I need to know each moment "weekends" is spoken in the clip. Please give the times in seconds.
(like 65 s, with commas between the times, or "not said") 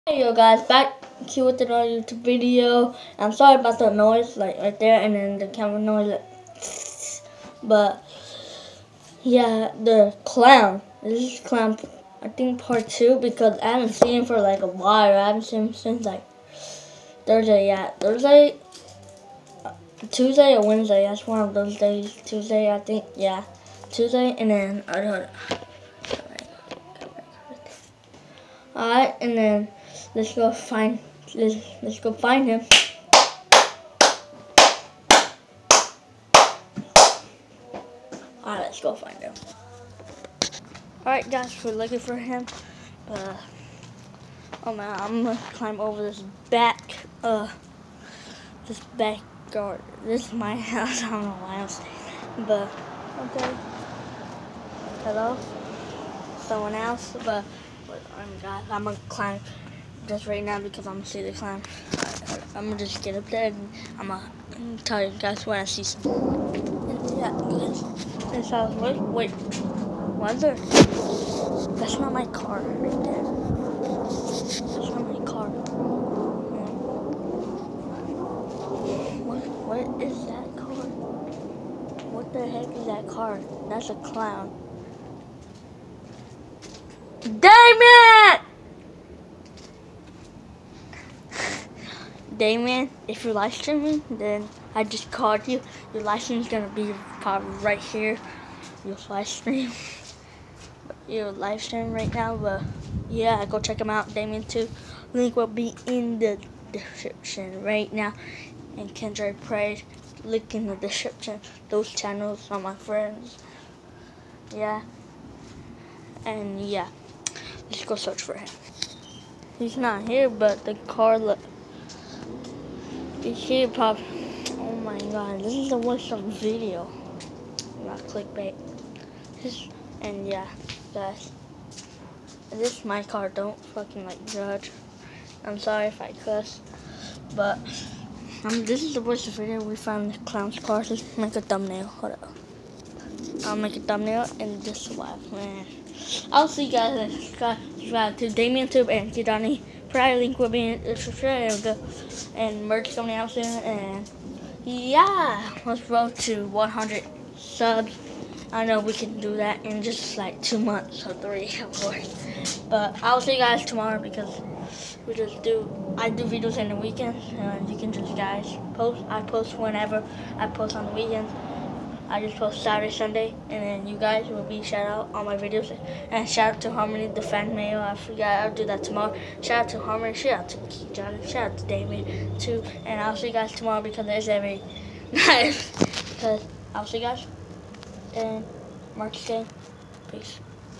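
166 s, 170 s.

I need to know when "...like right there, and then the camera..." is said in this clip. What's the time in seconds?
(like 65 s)
4 s.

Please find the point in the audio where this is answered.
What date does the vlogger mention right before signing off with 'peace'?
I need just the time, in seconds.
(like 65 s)
188 s.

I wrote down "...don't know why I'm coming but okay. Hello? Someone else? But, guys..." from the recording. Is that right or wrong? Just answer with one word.
wrong.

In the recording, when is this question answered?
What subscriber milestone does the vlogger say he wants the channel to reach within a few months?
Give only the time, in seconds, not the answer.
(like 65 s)
156 s.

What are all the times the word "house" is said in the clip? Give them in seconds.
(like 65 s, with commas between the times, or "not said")
50 s, 68 s.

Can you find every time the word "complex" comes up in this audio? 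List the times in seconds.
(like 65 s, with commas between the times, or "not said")
not said.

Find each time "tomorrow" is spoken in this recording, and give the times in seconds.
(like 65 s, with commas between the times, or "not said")
163 s, 178 s, 183 s.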